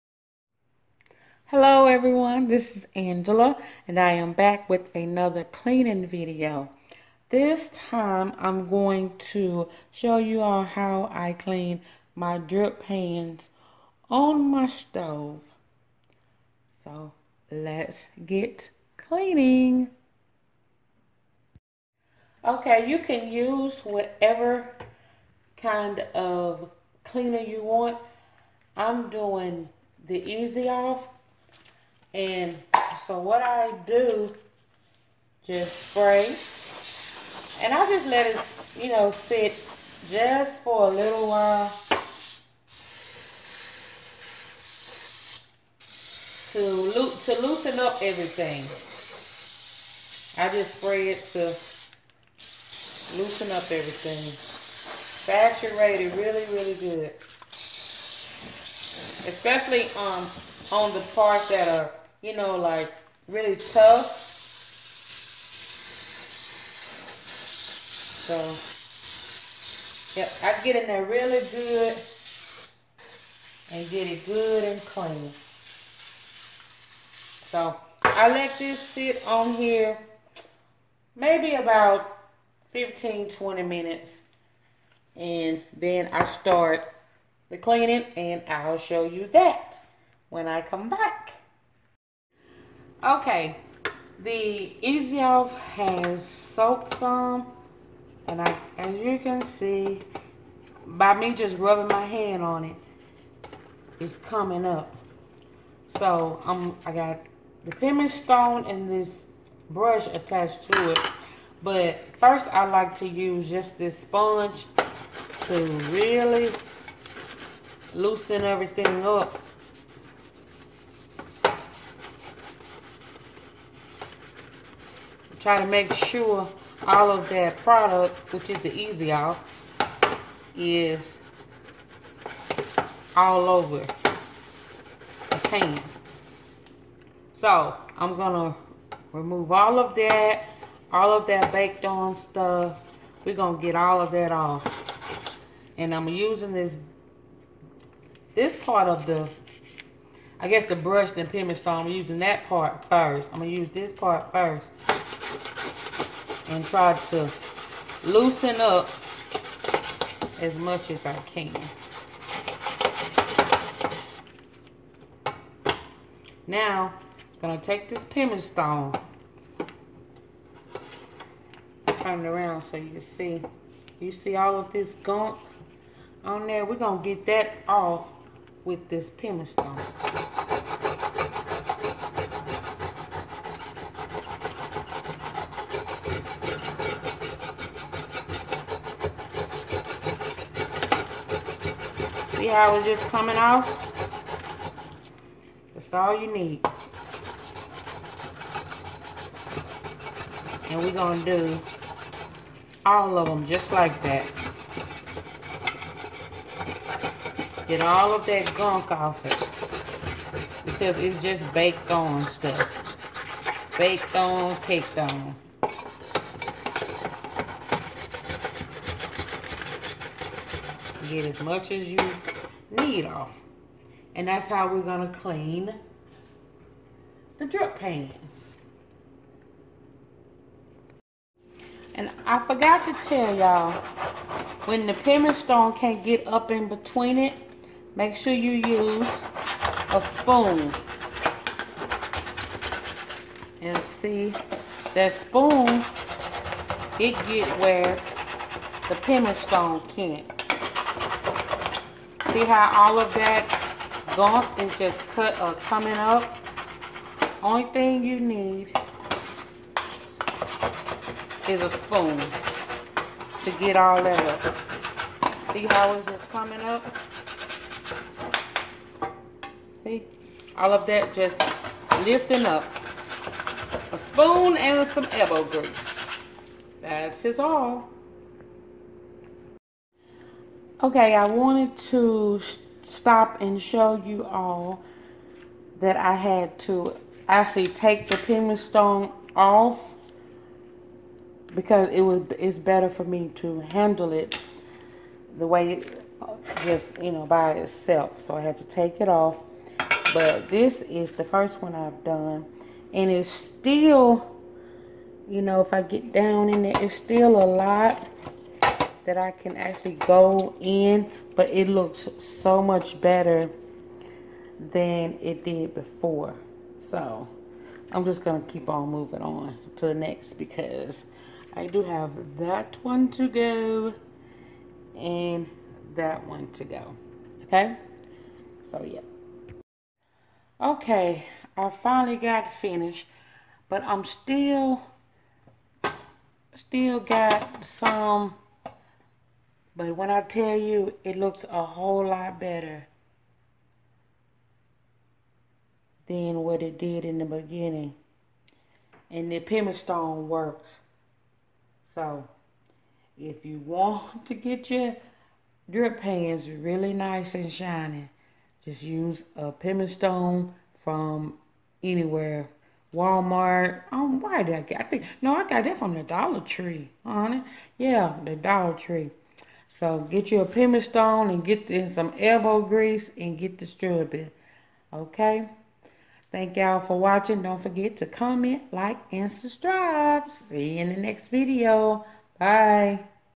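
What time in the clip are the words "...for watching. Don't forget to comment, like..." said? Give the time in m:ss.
6:16.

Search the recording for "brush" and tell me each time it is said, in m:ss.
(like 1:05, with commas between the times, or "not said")
1:49, 2:30.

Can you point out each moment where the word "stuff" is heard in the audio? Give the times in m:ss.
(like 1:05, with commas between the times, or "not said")
2:22, 3:32.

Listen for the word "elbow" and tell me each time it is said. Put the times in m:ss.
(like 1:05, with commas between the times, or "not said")
4:35, 6:12.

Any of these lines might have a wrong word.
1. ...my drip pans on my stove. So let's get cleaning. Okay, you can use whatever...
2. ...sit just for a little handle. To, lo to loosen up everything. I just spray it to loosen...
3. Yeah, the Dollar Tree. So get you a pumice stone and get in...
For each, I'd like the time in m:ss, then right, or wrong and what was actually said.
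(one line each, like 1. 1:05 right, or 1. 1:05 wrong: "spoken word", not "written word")
1. 0:12 right
2. 0:39 wrong: "while", not "handle"
3. 6:07 right.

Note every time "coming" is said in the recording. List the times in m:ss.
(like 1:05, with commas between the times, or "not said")
1:44, 3:13, 4:15, 4:26.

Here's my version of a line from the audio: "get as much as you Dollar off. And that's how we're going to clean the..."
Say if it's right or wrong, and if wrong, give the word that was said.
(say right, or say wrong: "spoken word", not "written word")
wrong: "Need", not "Dollar".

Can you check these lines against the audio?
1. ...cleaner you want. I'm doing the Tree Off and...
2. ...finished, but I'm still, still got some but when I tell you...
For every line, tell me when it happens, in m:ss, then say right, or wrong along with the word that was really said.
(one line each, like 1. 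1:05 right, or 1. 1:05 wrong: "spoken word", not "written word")
1. 0:27 wrong: "Easy", not "Tree"
2. 5:32 right.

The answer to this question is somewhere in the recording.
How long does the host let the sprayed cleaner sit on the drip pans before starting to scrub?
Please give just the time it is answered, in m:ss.
1:22.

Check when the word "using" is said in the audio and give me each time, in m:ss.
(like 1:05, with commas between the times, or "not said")
2:26, 2:31.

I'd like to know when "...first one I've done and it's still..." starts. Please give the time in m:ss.
5:01.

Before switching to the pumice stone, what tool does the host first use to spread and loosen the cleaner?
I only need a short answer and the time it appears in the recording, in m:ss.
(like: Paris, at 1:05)
Sponge, at 1:53.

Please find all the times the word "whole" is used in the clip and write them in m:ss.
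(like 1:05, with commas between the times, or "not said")
5:41.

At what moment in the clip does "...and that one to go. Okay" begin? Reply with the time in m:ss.
5:24.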